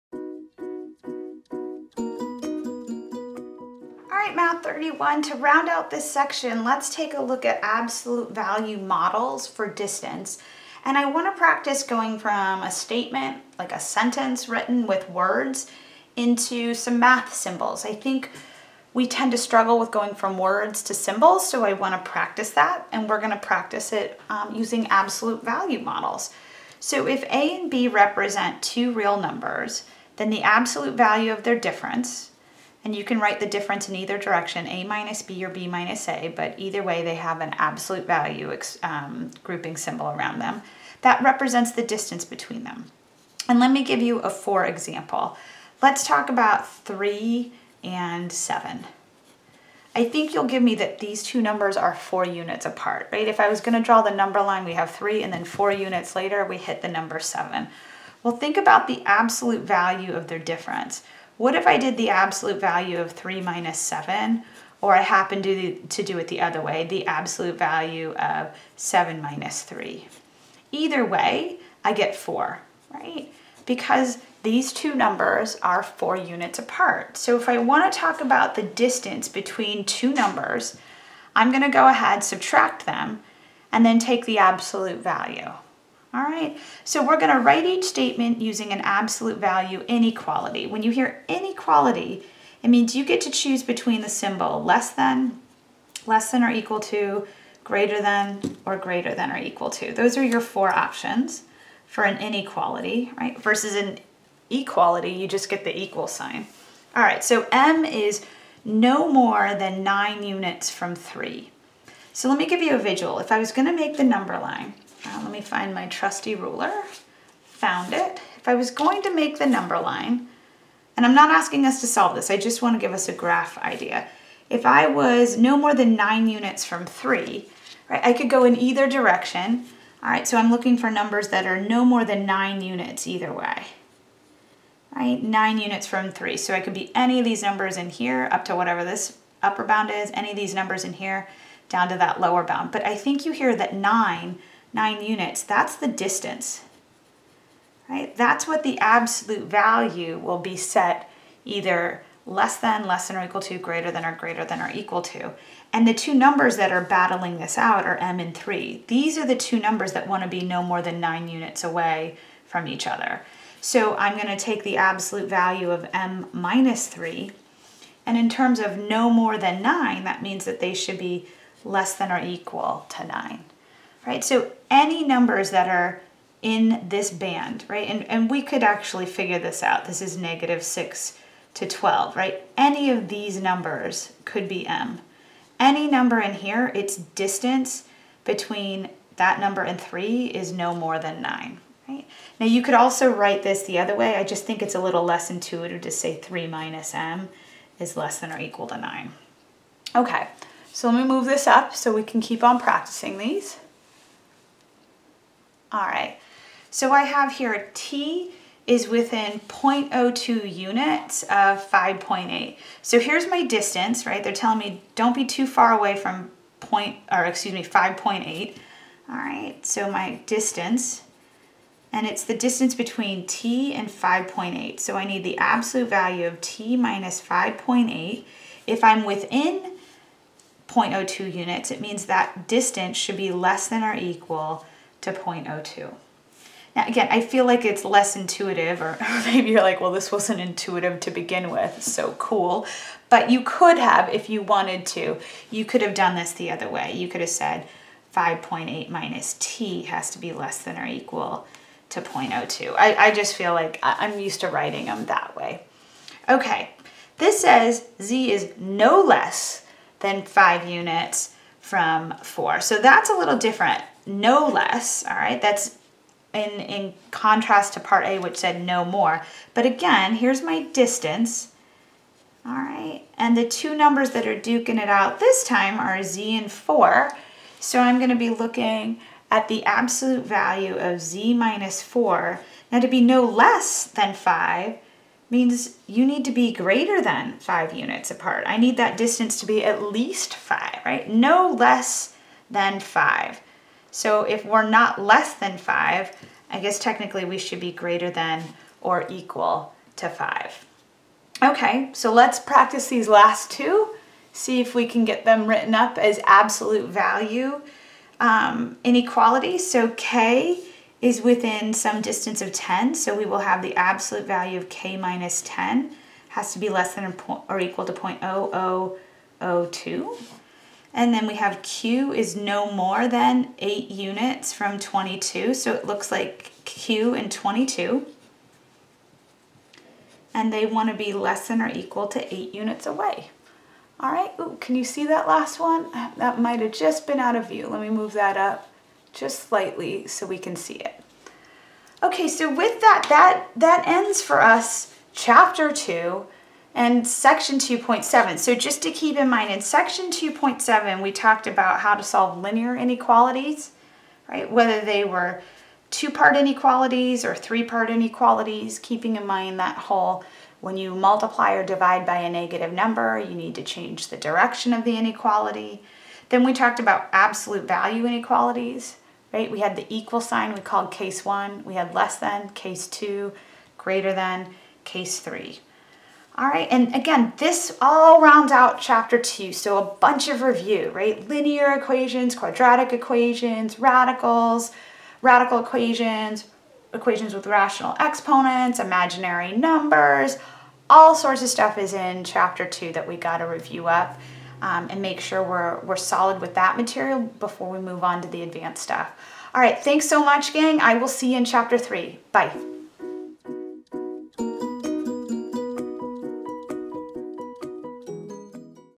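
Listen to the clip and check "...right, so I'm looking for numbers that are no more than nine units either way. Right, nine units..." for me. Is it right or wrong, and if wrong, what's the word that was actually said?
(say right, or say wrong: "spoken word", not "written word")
right.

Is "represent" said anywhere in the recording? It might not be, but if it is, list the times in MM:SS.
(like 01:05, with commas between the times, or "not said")
00:27, 00:41.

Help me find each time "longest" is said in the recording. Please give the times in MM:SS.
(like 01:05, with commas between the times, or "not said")
not said.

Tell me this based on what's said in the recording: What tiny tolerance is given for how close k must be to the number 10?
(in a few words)
0.0002.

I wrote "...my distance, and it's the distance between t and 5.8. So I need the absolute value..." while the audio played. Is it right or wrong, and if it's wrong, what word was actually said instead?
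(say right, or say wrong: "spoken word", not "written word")
right.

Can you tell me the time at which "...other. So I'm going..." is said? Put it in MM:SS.
02:42.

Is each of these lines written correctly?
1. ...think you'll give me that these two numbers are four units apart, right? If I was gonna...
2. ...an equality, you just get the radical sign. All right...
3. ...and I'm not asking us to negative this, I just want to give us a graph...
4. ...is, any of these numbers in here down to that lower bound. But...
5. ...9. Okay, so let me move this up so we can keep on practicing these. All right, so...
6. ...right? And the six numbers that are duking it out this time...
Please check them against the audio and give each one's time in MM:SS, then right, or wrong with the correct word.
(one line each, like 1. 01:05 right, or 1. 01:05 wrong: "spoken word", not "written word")
1. 00:50 right
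2. 01:43 wrong: "equal", not "radical"
3. 02:00 wrong: "solve", not "negative"
4. 02:19 right
5. 03:18 right
6. 04:32 wrong: "two", not "six".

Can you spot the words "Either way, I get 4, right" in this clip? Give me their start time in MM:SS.
01:10.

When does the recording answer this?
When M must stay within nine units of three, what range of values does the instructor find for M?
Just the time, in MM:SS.
03:00.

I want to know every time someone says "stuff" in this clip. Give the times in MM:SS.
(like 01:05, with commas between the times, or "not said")
06:31, 06:38.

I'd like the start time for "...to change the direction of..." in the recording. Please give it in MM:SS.
06:03.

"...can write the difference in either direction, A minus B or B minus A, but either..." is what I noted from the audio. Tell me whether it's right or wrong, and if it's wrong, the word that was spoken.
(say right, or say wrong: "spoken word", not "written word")
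right.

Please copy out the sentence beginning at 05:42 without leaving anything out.
Okay, so with that, that, that ends for us chapter 2 and section 2.7.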